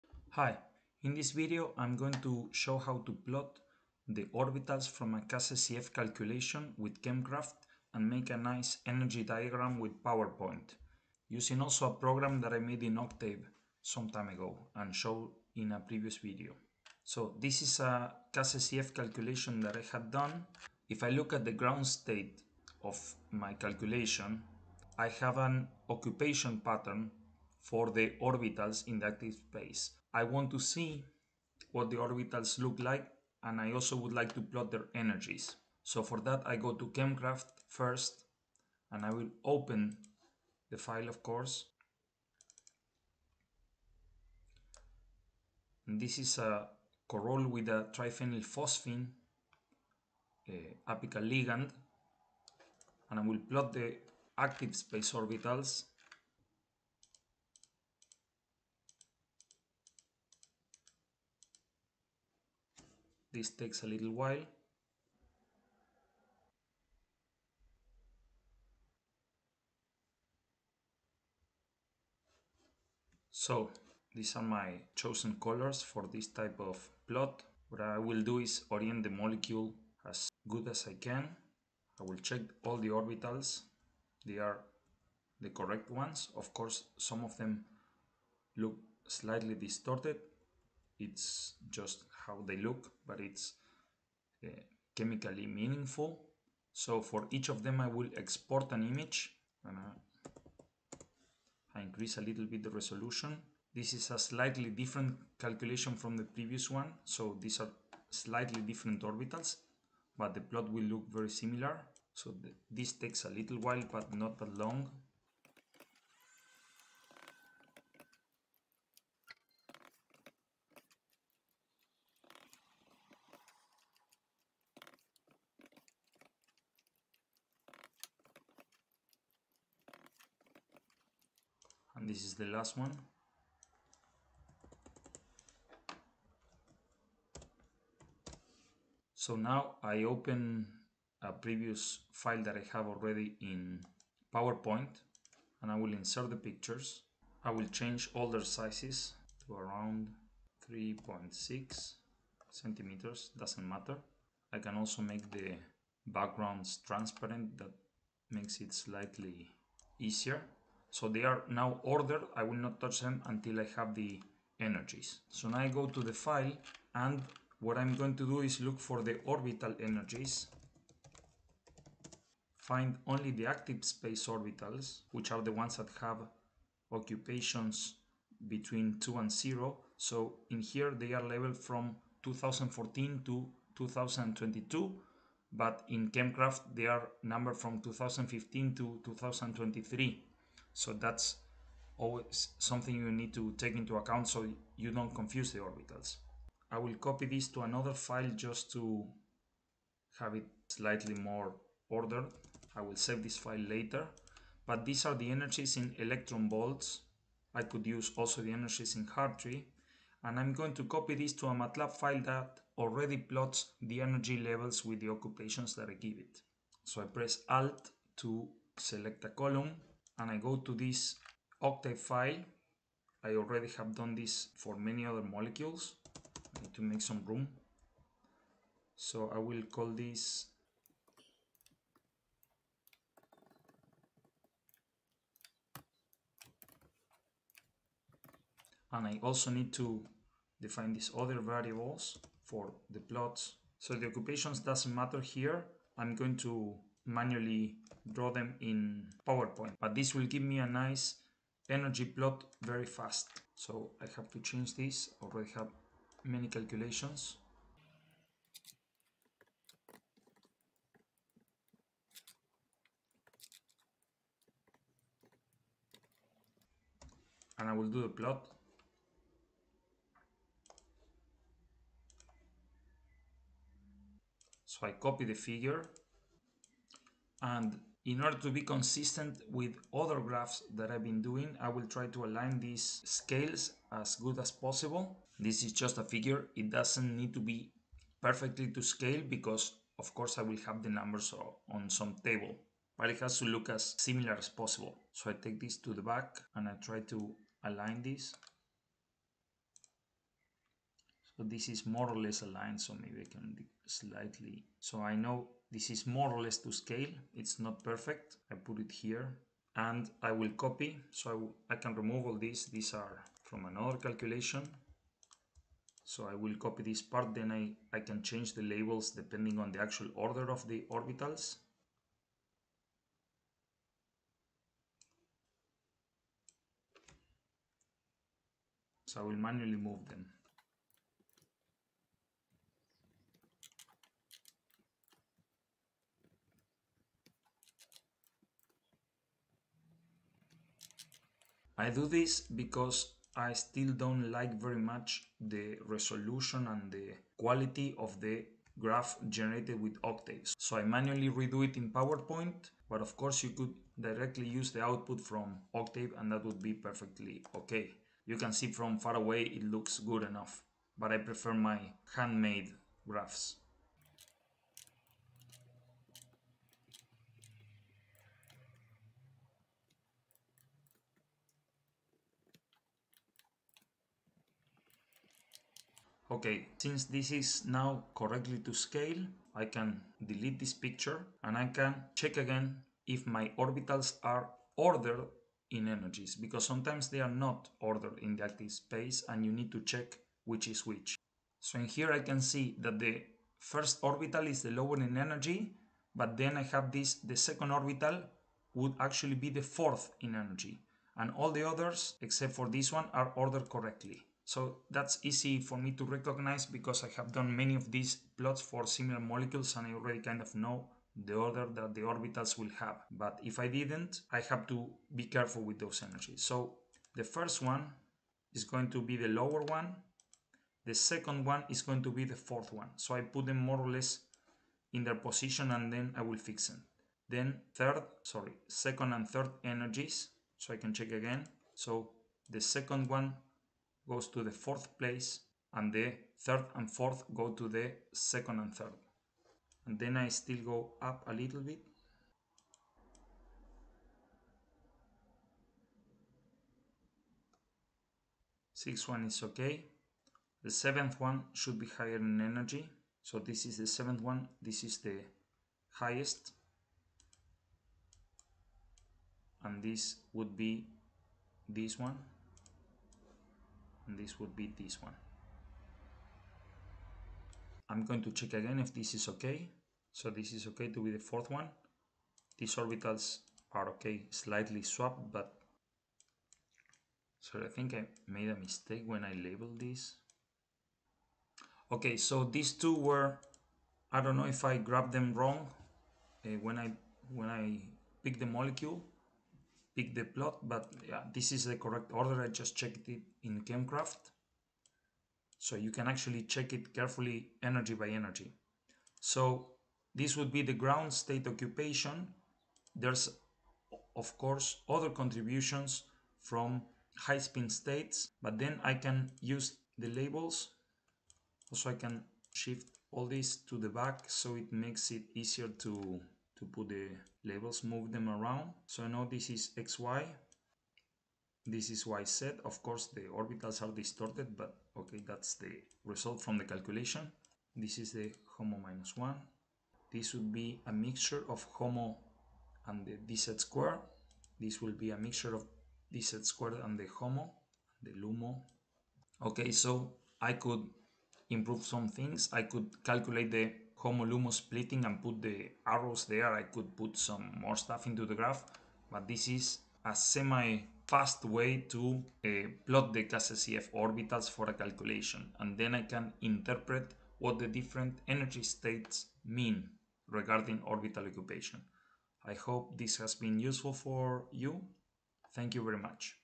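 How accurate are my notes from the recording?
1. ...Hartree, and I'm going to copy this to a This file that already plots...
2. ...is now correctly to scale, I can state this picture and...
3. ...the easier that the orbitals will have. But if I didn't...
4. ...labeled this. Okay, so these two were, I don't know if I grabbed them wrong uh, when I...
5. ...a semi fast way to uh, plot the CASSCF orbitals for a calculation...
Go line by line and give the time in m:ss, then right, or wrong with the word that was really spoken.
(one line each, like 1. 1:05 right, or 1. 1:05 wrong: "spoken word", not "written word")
1. 3:29 wrong: "MATLAB", not "This"
2. 6:17 wrong: "delete", not "state"
3. 6:51 wrong: "order", not "easier"
4. 7:59 right
5. 9:10 right.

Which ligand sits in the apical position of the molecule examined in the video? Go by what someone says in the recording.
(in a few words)
Triphenylphosphine.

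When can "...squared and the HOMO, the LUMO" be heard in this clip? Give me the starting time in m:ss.
8:56.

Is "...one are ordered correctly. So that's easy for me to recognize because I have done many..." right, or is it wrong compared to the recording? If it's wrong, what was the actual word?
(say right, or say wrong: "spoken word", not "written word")
right.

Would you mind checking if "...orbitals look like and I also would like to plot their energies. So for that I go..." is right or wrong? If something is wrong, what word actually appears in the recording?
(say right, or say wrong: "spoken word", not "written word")
right.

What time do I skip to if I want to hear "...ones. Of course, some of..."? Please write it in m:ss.
1:25.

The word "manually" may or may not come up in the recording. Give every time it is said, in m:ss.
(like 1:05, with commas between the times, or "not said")
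4:07, 5:29, 5:50.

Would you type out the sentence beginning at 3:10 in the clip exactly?
So that's always something you need to take into account so you don't confuse the orbitals.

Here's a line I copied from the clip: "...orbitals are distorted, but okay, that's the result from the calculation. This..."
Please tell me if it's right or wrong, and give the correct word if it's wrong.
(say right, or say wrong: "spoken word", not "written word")
right.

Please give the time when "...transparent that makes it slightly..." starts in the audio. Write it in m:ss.
2:36.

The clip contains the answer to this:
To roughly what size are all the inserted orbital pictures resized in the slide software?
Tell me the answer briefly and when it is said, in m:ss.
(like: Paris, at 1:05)
3.6 centimeters, at 2:30.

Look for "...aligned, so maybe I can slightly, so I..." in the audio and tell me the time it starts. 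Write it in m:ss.
5:02.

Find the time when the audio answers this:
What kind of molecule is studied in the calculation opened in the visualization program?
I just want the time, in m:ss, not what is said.
0:47.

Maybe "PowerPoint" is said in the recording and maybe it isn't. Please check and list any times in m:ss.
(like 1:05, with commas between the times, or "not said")
0:10, 2:24, 4:09, 5:51.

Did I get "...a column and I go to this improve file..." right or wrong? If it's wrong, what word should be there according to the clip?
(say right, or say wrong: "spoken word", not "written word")
wrong: "octave", not "improve".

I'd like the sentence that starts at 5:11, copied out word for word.
So I, I can remove all these.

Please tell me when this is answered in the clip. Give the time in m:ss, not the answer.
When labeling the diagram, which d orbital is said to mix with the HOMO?
8:53.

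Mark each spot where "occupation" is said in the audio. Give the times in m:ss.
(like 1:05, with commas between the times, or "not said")
0:25, 2:56, 3:35, 4:04, 8:21, 9:21.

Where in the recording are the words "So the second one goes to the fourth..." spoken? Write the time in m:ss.
7:11.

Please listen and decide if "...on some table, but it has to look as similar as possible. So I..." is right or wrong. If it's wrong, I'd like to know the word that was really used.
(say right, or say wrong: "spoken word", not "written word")
right.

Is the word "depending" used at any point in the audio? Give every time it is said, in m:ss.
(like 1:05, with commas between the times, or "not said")
5:19.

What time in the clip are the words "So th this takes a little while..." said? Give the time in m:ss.
1:52.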